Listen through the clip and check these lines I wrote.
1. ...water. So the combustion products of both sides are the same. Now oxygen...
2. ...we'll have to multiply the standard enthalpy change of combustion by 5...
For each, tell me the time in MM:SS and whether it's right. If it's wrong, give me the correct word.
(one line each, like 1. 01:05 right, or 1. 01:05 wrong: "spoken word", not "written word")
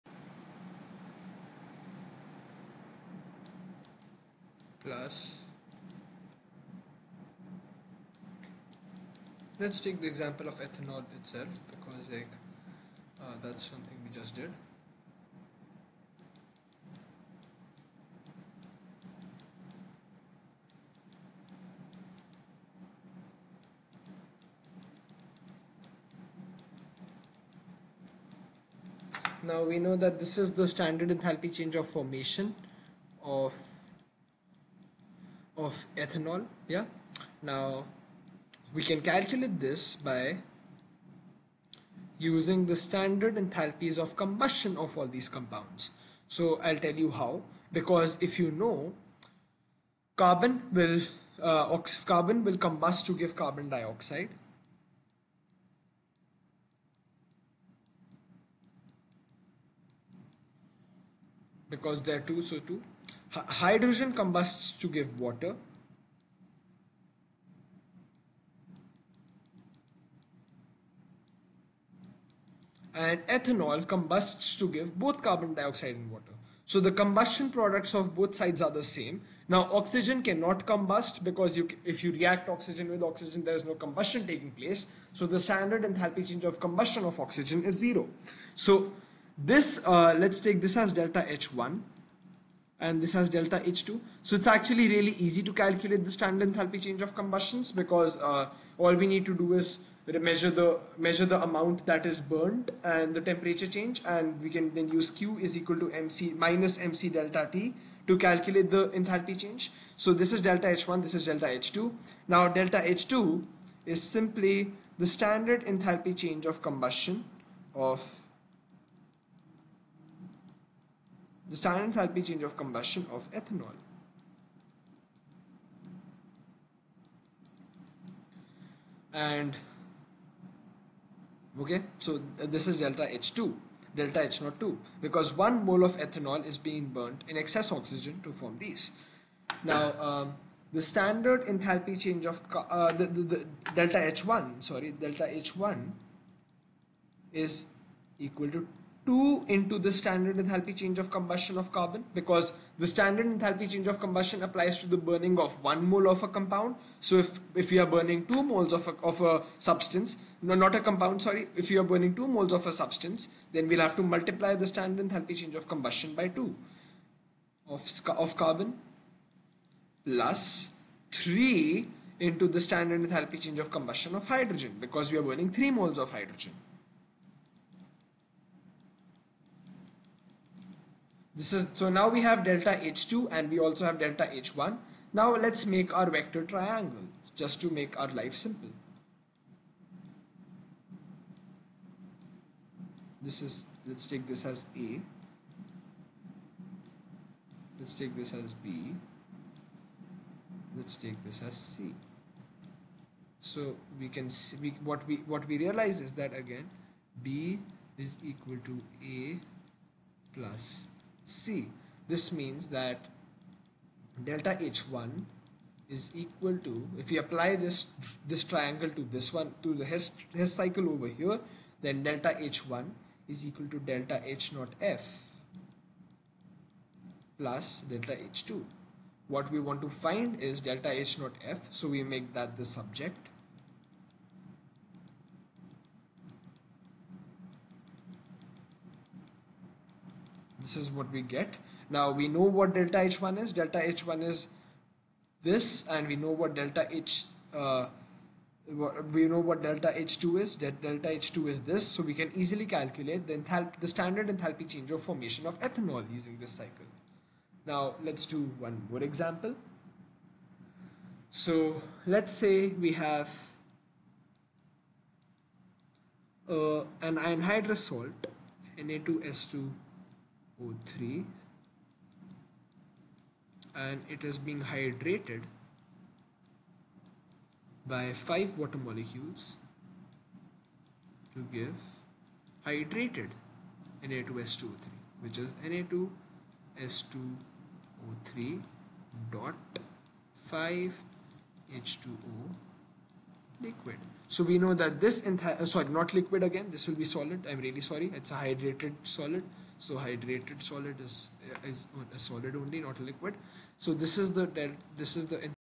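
1. 01:16 right
2. 02:43 wrong: "2", not "5".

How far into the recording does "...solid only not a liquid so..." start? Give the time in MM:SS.
05:02.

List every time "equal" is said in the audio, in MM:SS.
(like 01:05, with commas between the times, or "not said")
01:45, 02:28, 03:28, 03:36, 03:43.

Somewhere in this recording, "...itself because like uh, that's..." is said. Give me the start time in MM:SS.
00:11.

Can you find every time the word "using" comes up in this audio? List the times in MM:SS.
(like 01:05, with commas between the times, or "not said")
00:42, 04:16.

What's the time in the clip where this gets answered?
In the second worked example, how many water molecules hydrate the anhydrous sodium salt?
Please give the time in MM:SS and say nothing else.
04:38.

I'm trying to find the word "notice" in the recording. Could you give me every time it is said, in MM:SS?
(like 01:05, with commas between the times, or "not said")
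not said.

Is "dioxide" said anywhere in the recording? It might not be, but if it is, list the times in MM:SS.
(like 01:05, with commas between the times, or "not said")
00:53, 01:15.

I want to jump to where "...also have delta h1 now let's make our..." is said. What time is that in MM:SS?
03:03.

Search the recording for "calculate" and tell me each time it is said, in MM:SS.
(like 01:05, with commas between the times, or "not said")
00:39, 01:35, 01:48, 04:12.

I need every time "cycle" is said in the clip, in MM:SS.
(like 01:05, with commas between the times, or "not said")
03:40, 04:16.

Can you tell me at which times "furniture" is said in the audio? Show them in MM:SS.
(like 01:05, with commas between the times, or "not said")
not said.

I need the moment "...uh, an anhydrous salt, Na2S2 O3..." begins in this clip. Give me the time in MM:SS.
04:26.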